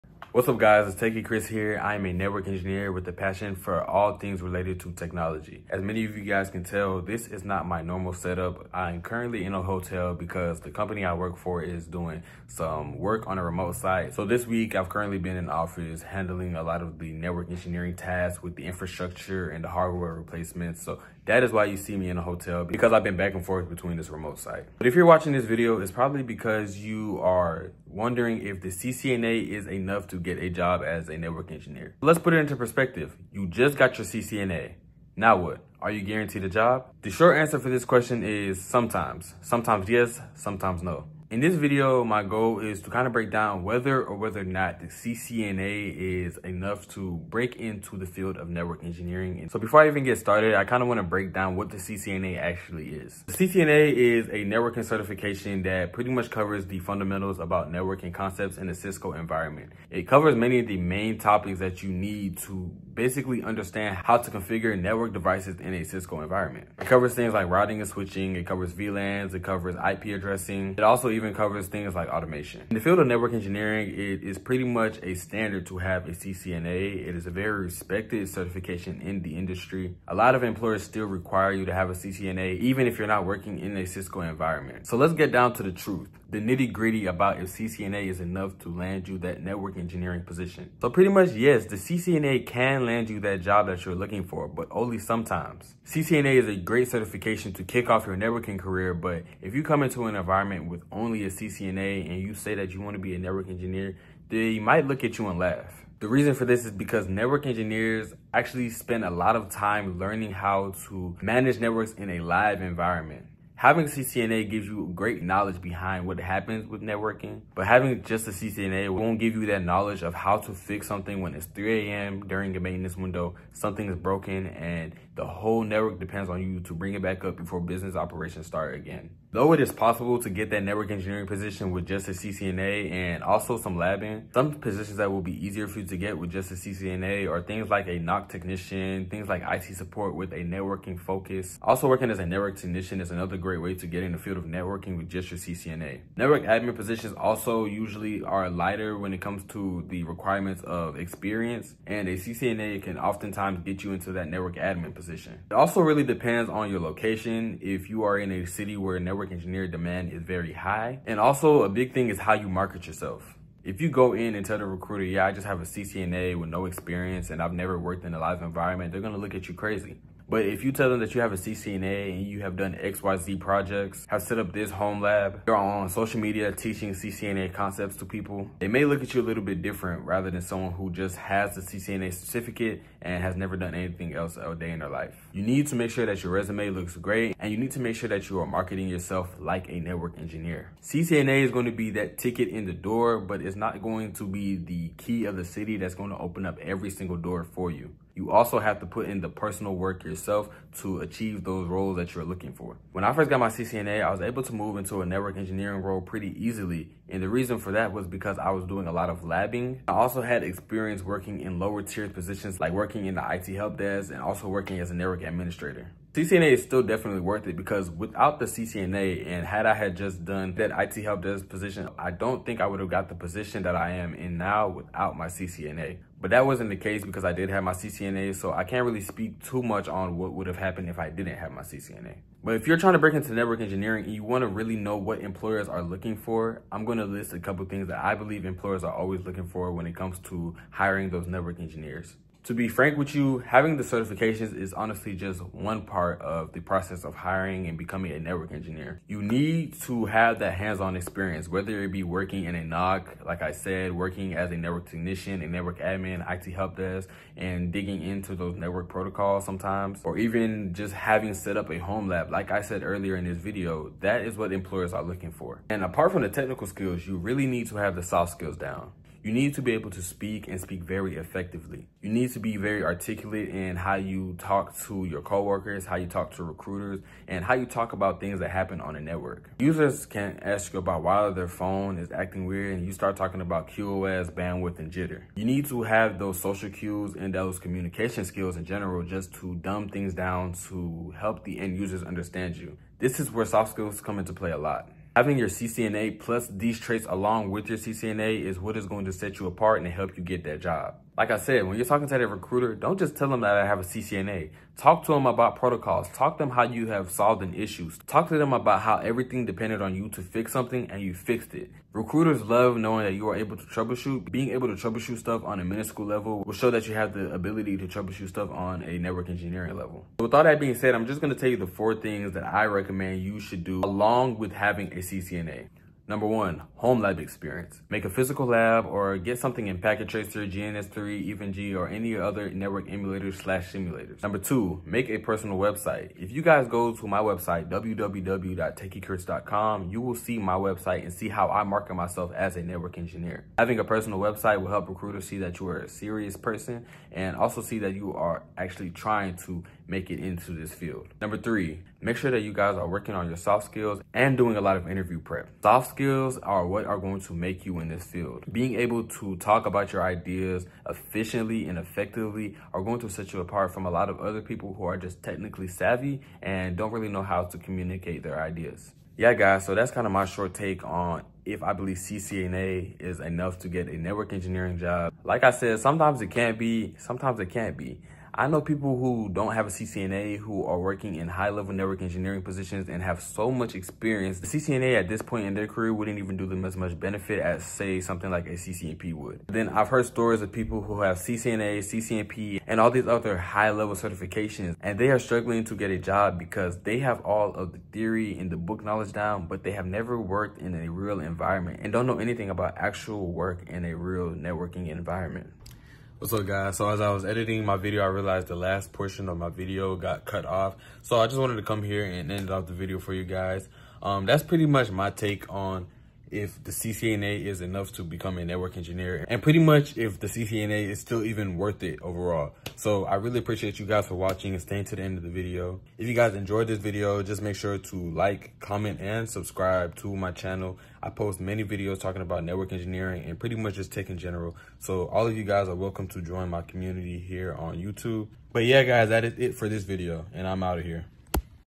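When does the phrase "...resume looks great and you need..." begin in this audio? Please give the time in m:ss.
3:06.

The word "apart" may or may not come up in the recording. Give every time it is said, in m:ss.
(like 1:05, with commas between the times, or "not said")
4:25, 4:59, 6:03.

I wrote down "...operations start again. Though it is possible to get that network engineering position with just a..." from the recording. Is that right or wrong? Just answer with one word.
right.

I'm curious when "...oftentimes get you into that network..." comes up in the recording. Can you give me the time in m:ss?
2:32.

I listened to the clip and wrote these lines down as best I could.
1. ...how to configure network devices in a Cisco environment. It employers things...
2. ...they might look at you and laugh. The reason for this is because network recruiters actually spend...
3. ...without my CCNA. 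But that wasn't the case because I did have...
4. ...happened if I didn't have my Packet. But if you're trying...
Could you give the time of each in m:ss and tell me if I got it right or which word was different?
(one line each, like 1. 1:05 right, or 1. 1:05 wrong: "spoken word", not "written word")
1. 1:03 wrong: "covers", not "employers"
2. 1:44 wrong: "engineers", not "recruiters"
3. 3:44 right
4. 3:50 wrong: "CCNA", not "Packet".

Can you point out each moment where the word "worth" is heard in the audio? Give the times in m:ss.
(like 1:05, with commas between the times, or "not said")
3:37, 7:01.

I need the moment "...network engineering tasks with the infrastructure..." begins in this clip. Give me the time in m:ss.
0:17.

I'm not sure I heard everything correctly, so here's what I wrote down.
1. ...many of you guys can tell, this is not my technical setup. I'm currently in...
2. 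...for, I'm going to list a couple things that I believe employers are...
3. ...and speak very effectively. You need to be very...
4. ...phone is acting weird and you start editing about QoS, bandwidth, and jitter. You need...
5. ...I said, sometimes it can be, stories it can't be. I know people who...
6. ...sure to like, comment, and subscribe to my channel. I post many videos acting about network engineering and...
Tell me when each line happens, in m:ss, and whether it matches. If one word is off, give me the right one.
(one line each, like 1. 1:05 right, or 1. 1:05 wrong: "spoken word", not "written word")
1. 0:05 wrong: "normal", not "technical"
2. 3:56 right
3. 4:30 right
4. 4:41 wrong: "talking", not "editing"
5. 6:15 wrong: "sometimes", not "stories"
6. 7:07 wrong: "talking", not "acting".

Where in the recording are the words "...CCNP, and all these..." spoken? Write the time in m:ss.
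6:31.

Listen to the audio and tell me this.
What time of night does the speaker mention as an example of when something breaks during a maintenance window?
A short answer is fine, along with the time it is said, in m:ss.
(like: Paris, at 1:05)
3 a.m., at 2:01.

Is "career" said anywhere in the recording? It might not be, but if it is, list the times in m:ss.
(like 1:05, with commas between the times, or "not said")
1:38, 6:25.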